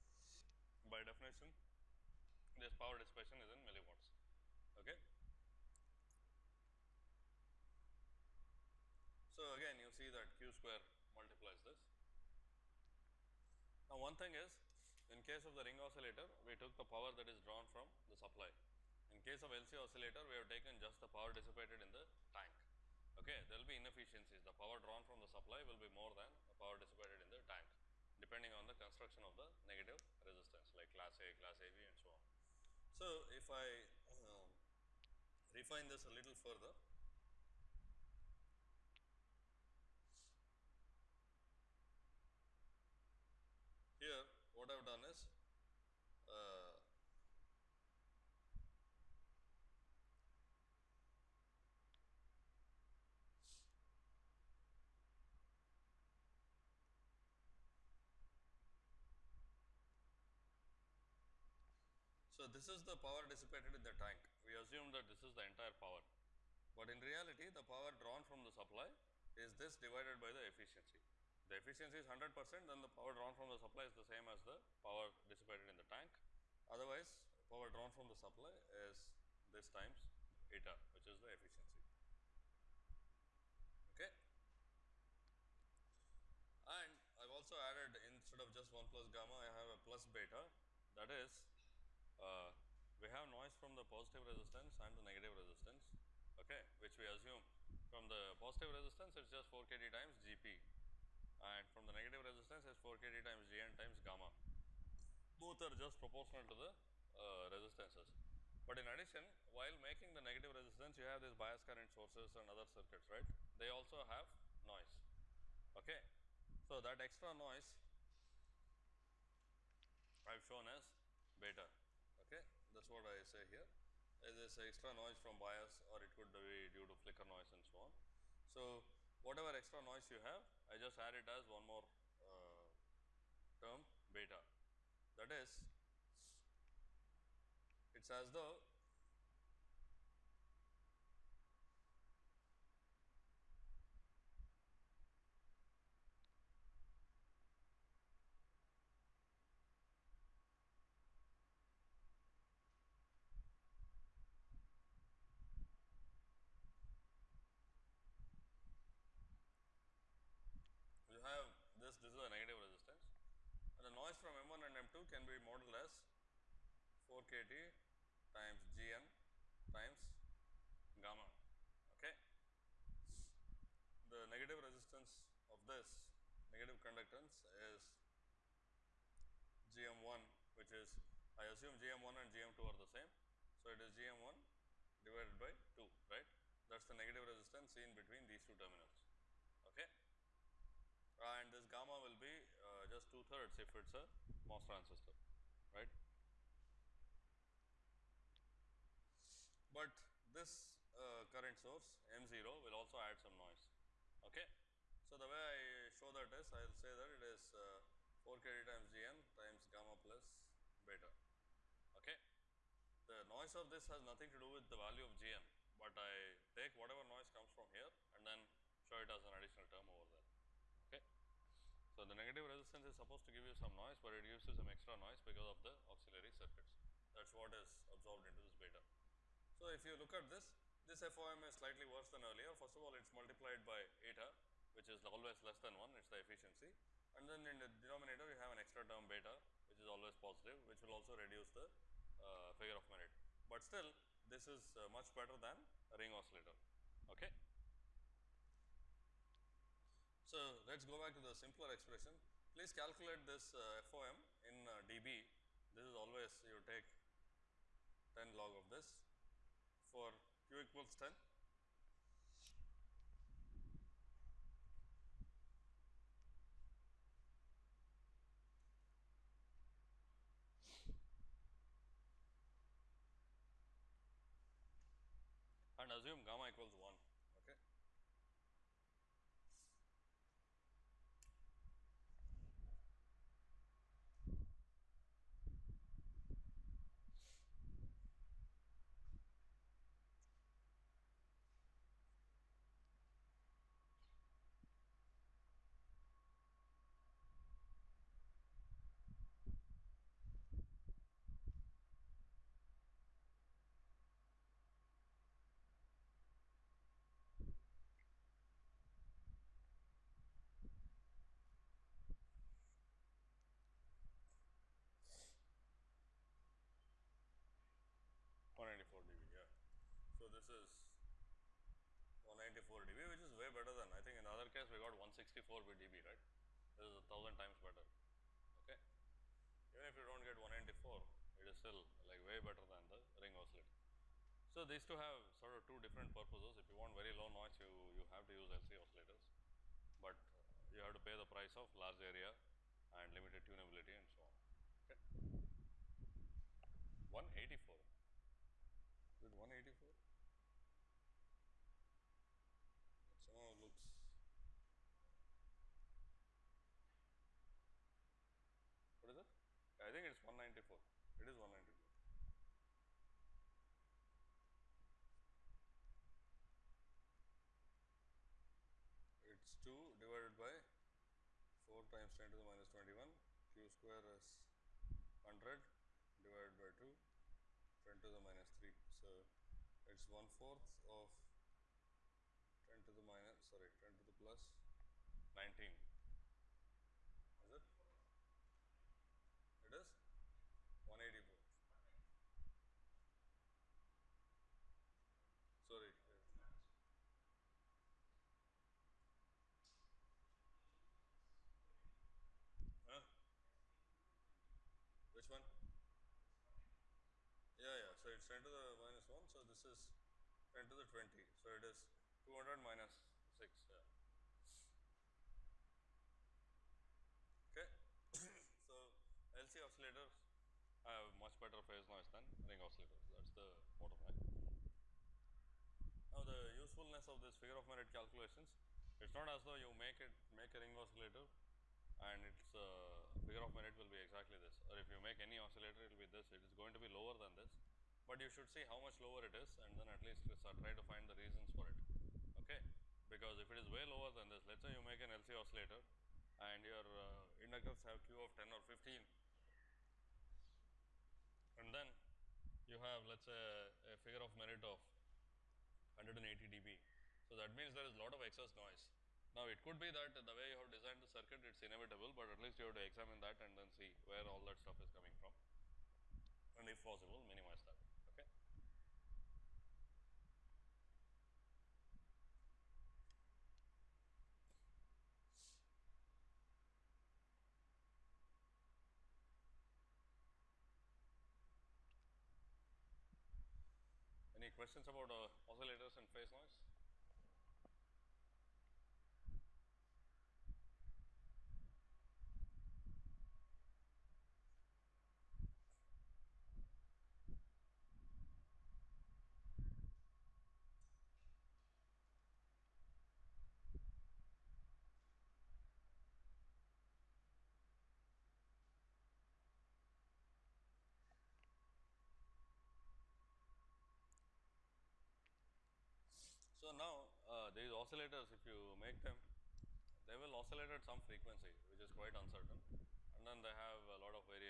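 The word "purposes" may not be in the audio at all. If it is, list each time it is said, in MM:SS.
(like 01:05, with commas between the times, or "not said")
05:36.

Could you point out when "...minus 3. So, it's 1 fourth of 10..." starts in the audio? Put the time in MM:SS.
06:18.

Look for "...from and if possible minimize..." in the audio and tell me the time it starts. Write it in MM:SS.
07:45.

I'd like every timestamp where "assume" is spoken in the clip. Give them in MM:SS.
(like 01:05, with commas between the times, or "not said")
01:04, 01:37, 03:01, 04:35.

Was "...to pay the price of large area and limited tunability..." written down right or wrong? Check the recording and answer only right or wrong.
right.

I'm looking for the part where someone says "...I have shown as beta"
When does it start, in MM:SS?
02:00.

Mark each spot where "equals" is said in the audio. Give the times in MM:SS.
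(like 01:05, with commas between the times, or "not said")
04:20, 04:36.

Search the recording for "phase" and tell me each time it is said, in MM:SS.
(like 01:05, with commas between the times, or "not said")
07:01, 08:06.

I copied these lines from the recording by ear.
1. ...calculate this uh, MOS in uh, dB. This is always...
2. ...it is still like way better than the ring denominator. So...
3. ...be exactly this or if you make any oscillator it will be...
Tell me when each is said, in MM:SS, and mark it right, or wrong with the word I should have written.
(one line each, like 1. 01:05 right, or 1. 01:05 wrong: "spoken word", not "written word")
1. 04:12 wrong: "FOM", not "MOS"
2. 05:31 wrong: "oscillator", not "denominator"
3. 07:13 right.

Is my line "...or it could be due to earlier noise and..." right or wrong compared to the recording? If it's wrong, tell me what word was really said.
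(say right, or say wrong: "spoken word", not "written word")
wrong: "flicker", not "earlier".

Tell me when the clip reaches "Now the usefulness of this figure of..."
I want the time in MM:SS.
07:06.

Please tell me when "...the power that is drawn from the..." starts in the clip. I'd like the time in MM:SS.
00:16.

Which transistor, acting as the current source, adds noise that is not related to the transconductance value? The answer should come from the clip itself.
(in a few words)
M0.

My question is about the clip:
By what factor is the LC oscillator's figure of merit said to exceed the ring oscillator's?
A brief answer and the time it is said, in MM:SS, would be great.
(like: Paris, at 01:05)
1000, at 05:26.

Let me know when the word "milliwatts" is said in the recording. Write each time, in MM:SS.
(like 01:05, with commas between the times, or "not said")
00:03.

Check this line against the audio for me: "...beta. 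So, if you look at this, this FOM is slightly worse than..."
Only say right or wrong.
right.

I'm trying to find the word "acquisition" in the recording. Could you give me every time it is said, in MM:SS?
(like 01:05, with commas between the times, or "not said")
not said.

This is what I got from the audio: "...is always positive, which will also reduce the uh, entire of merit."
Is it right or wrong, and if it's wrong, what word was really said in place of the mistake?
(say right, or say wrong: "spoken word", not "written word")
wrong: "figure", not "entire".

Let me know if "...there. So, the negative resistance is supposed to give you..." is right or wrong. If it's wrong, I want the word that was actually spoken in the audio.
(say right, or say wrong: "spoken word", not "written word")
right.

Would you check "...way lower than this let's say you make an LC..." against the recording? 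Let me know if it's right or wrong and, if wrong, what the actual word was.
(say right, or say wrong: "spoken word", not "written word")
right.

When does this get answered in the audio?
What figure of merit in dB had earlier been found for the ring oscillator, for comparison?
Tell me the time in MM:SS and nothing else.
05:25.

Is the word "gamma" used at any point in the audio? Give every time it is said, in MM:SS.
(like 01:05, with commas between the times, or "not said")
01:29, 01:43, 02:51, 03:11, 03:29, 04:36.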